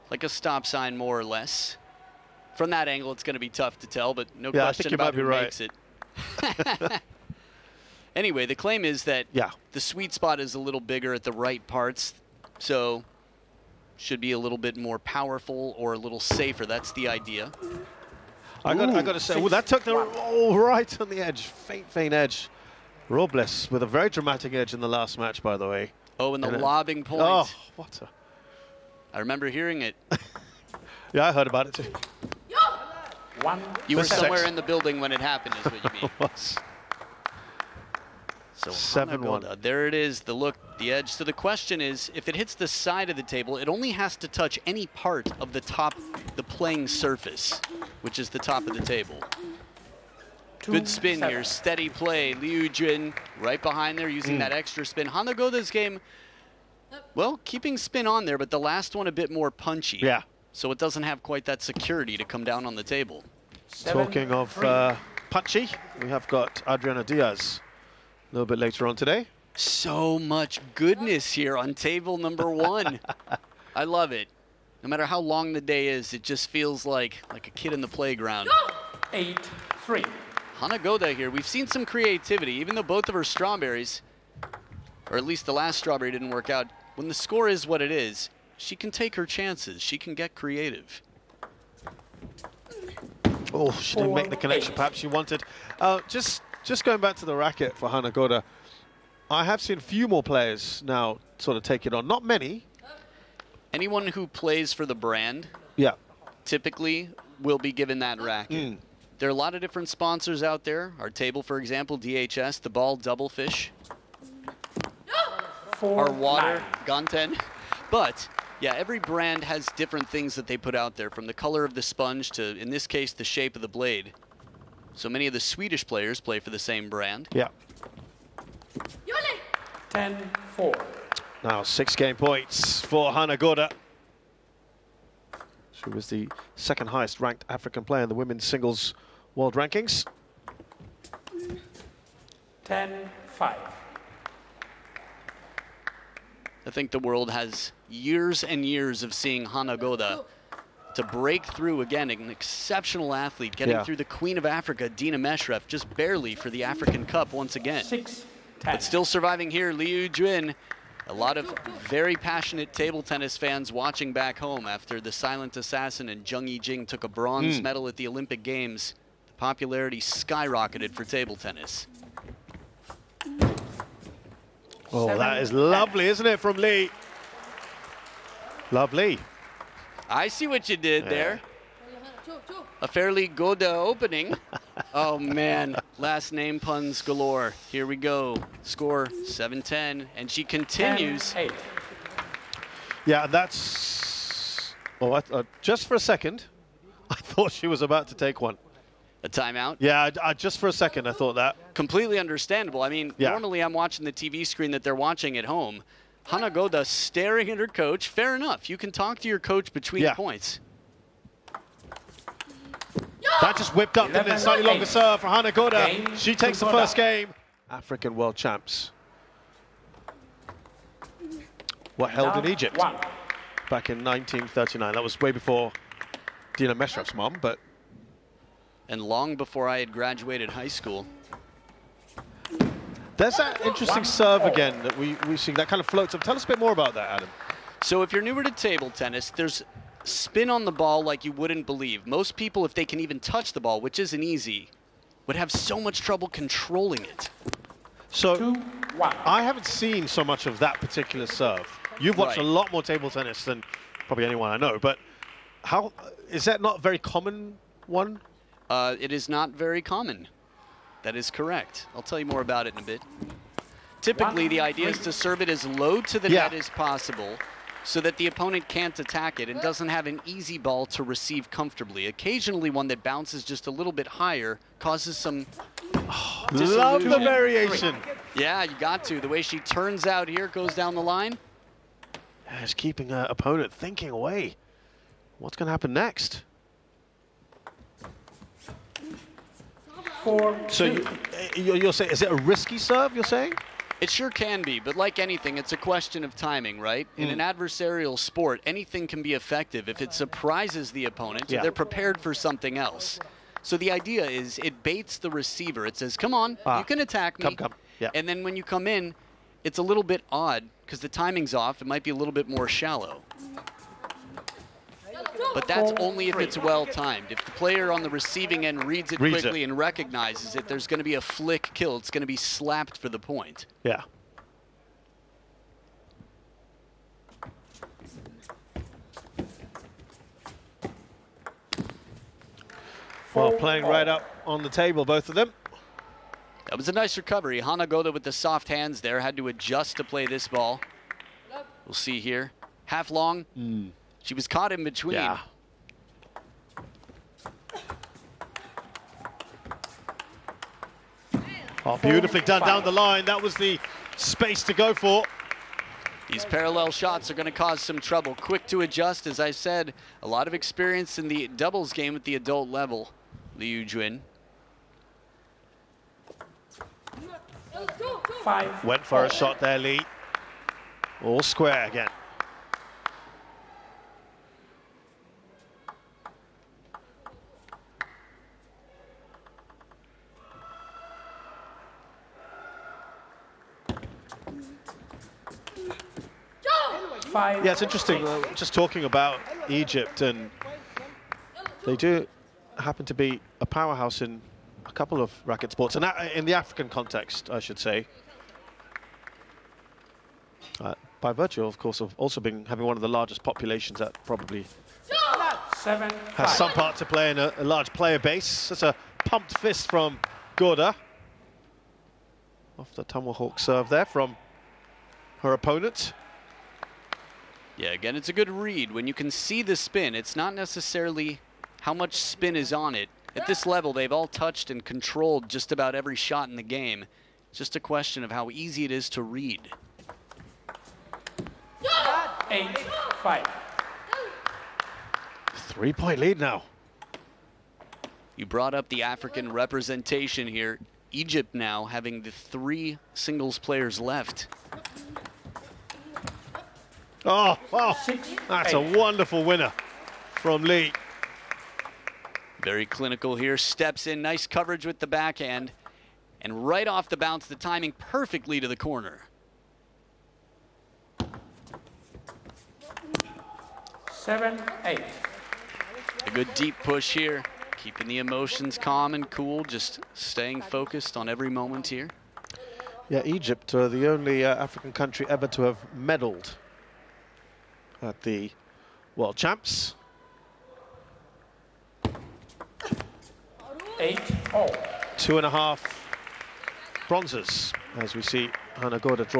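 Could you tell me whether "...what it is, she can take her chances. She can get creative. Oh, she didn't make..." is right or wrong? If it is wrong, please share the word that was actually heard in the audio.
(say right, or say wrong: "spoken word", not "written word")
right.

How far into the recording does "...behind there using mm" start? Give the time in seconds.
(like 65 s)
53 s.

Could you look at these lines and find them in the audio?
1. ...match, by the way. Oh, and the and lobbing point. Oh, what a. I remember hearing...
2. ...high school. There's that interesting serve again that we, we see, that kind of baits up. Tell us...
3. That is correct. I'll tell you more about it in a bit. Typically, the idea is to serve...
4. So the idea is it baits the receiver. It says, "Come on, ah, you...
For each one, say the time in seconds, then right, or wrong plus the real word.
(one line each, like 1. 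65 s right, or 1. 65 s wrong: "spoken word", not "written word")
1. 25 s right
2. 230 s wrong: "floats", not "baits"
3. 261 s right
4. 303 s right.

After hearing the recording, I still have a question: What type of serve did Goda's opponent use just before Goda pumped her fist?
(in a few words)
tomahawk serve.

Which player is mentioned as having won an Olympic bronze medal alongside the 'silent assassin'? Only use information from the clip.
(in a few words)
Cheng I-Ching.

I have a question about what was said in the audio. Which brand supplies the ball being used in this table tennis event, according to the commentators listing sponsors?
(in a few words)
Double Fish.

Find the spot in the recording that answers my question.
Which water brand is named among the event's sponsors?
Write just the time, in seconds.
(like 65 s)
117 s.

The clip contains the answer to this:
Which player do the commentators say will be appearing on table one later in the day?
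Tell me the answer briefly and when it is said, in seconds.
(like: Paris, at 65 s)
Adriana Diaz, at 66 s.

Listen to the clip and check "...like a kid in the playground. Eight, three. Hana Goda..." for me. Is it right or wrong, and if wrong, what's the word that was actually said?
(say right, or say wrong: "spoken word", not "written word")
right.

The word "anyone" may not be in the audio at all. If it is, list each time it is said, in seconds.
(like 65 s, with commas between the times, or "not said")
103 s, 254 s.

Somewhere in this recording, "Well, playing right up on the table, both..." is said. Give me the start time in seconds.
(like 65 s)
333 s.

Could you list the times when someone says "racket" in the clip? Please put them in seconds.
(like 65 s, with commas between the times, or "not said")
97 s, 108 s, 395 s.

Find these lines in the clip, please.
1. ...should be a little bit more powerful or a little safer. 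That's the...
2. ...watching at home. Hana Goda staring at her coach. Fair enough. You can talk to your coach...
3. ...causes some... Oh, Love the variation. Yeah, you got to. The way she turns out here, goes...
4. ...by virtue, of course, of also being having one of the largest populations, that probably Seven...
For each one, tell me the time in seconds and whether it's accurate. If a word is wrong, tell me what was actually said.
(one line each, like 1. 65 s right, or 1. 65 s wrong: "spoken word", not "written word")
1. 13 s right
2. 204 s right
3. 274 s right
4. 401 s right.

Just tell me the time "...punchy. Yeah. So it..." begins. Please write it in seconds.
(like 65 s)
59 s.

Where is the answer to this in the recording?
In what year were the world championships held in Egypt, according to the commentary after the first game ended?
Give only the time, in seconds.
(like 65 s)
224 s.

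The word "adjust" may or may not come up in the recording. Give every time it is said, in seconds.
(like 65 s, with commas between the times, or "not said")
339 s, 358 s.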